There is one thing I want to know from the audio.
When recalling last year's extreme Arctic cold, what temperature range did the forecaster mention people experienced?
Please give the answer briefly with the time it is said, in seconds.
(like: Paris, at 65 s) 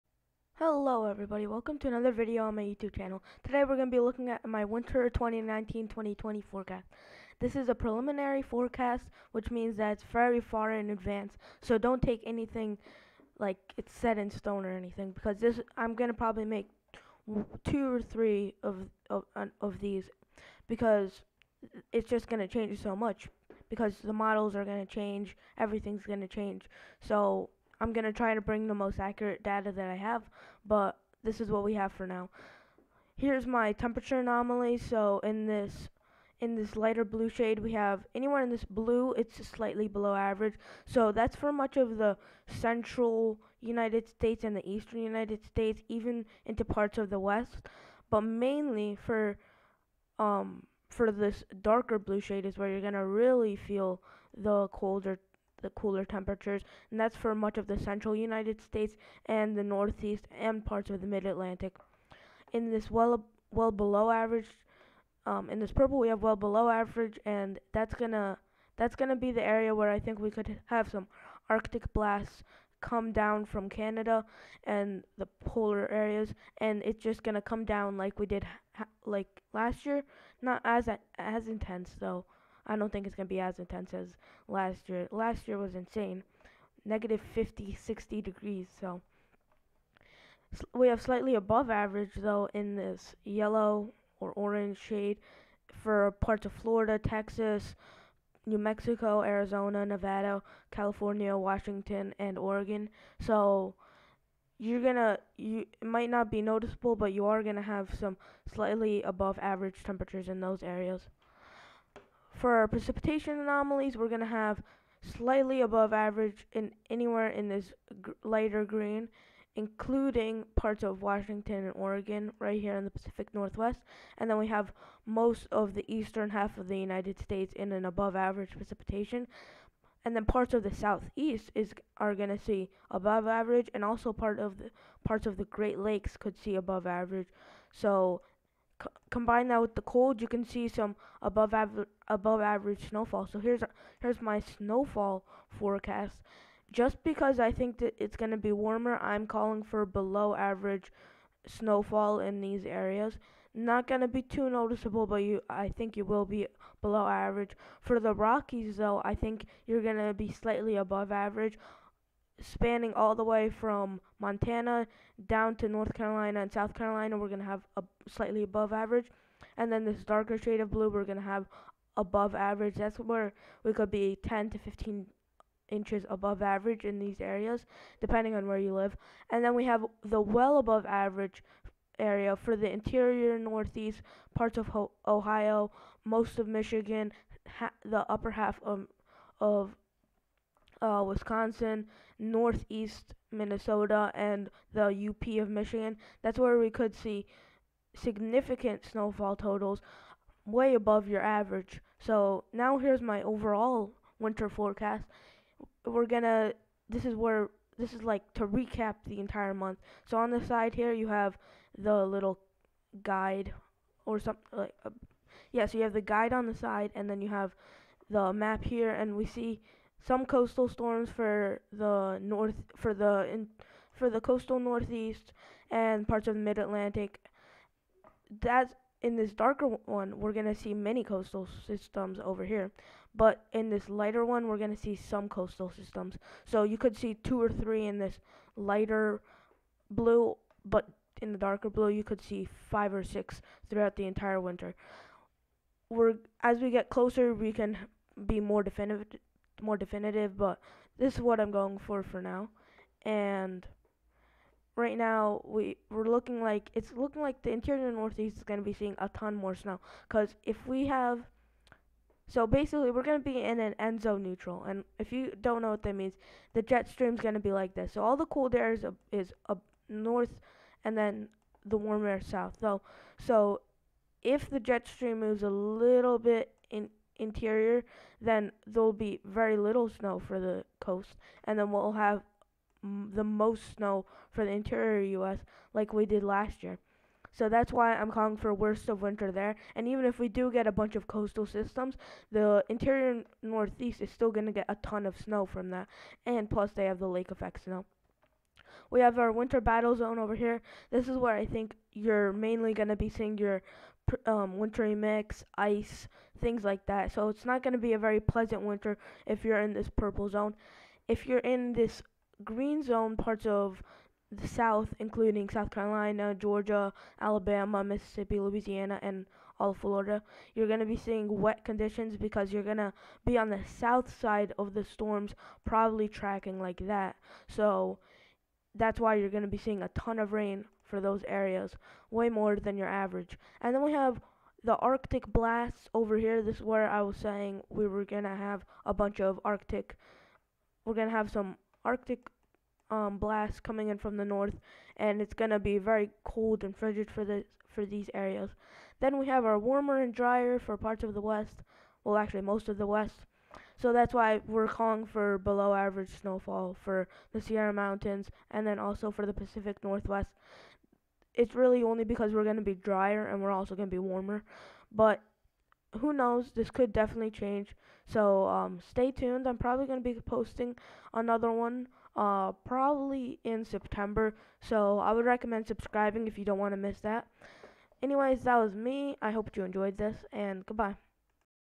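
-50 to 60 degrees, at 86 s.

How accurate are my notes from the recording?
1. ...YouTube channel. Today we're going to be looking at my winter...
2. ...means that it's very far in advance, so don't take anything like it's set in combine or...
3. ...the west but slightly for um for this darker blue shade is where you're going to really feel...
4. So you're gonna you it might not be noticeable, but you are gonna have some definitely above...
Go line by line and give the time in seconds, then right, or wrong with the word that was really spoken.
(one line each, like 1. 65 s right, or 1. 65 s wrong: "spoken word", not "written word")
1. 2 s right
2. 9 s wrong: "stone", not "combine"
3. 47 s wrong: "mainly", not "slightly"
4. 103 s wrong: "slightly", not "definitely".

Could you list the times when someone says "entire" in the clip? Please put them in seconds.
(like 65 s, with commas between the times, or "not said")
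209 s, 244 s.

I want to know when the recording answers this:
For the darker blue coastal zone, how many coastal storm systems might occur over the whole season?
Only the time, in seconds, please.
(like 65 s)
242 s.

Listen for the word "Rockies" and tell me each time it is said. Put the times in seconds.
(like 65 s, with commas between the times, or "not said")
158 s.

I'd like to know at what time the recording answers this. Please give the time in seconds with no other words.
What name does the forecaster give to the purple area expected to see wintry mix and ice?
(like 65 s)
299 s.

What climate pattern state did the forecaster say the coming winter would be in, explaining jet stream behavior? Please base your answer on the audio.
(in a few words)
ENSO neutral.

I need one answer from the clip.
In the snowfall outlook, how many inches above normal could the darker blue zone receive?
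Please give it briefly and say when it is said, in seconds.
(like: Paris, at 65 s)
10 to 15 inches, at 174 s.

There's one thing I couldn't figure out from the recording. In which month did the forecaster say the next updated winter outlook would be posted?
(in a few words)
September.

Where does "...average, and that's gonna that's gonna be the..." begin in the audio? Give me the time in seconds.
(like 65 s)
66 s.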